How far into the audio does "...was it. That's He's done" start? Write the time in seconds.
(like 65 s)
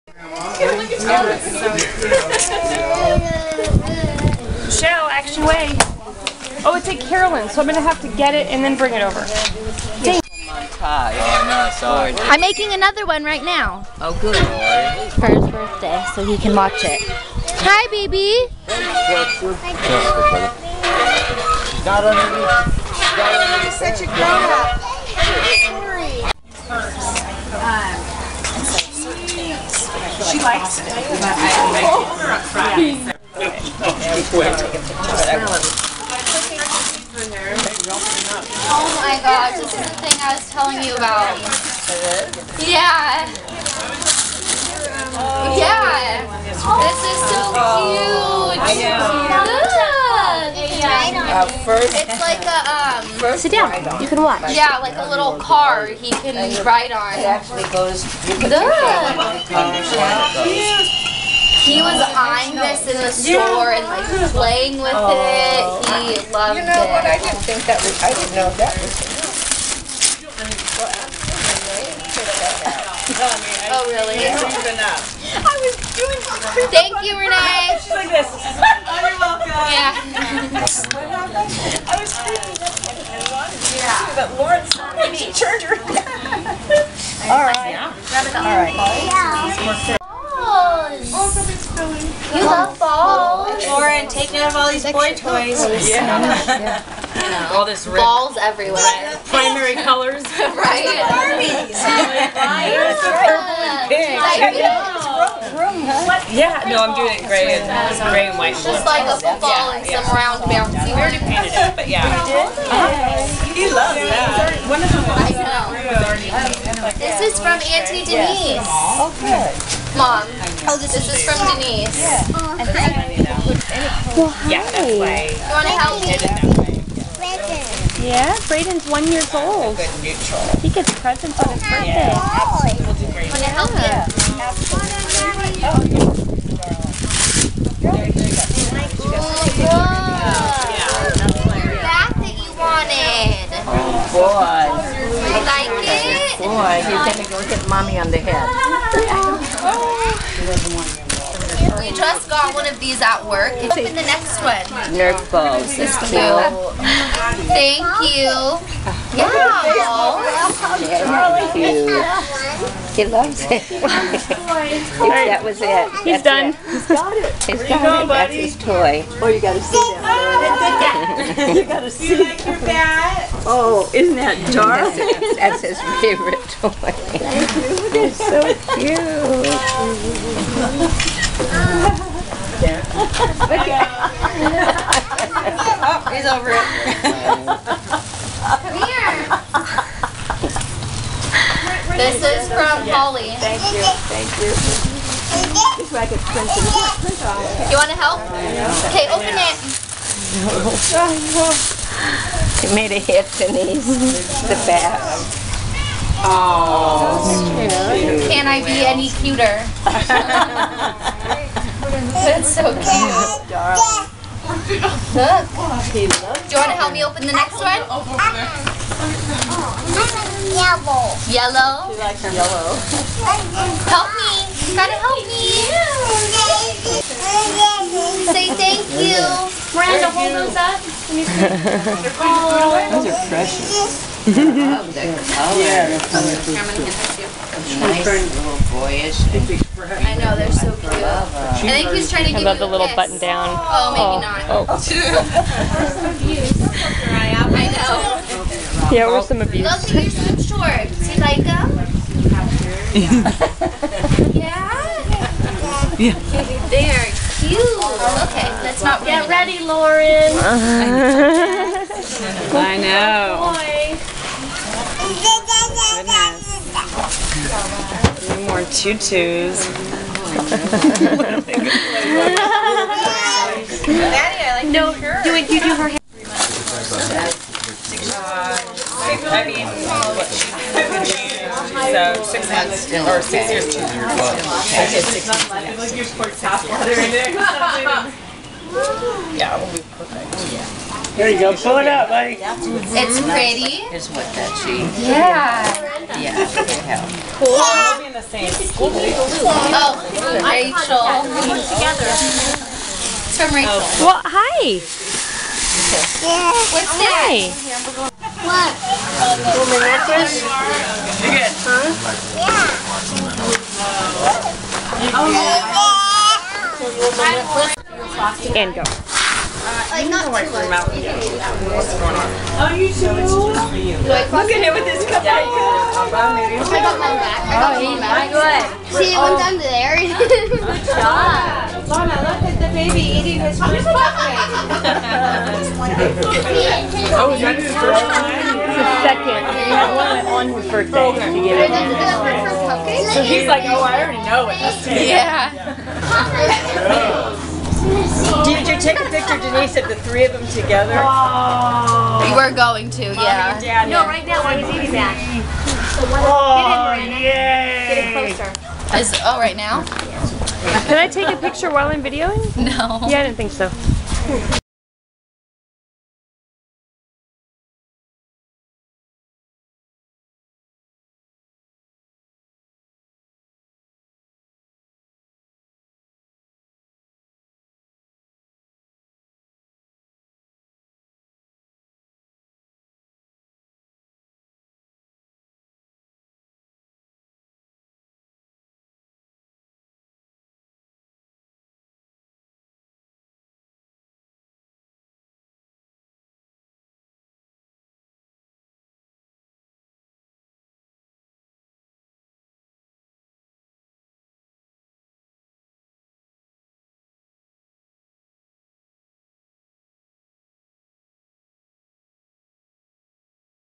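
165 s.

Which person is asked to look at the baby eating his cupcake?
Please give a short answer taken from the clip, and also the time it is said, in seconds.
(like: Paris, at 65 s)
Lana, at 331 s.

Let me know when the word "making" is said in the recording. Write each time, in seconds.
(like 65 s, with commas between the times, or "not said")
12 s.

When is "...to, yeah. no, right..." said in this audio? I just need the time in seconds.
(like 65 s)
352 s.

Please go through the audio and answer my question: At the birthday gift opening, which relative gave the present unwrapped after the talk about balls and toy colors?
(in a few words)
Auntie Denise.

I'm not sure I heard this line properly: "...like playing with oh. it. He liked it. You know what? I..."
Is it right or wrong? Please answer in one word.
wrong.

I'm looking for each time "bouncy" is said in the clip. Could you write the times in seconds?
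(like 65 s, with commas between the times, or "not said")
110 s.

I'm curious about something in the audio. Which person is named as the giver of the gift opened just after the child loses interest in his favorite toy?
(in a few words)
Holly.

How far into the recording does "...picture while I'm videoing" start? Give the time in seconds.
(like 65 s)
361 s.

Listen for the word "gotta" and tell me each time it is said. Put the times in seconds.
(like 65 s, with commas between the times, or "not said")
171 s, 224 s.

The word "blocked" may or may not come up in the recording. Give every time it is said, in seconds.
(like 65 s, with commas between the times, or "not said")
not said.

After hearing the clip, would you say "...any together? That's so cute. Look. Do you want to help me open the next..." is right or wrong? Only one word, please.
wrong.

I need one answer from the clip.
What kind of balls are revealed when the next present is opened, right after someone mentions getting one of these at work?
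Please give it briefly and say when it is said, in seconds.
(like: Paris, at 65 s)
Nerf balls, at 154 s.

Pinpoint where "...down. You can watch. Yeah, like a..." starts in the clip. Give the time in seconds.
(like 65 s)
53 s.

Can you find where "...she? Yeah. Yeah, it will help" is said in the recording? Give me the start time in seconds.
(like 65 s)
294 s.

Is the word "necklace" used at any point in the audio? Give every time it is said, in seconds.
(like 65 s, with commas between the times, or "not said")
309 s, 317 s.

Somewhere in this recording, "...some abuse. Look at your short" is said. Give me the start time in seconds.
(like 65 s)
249 s.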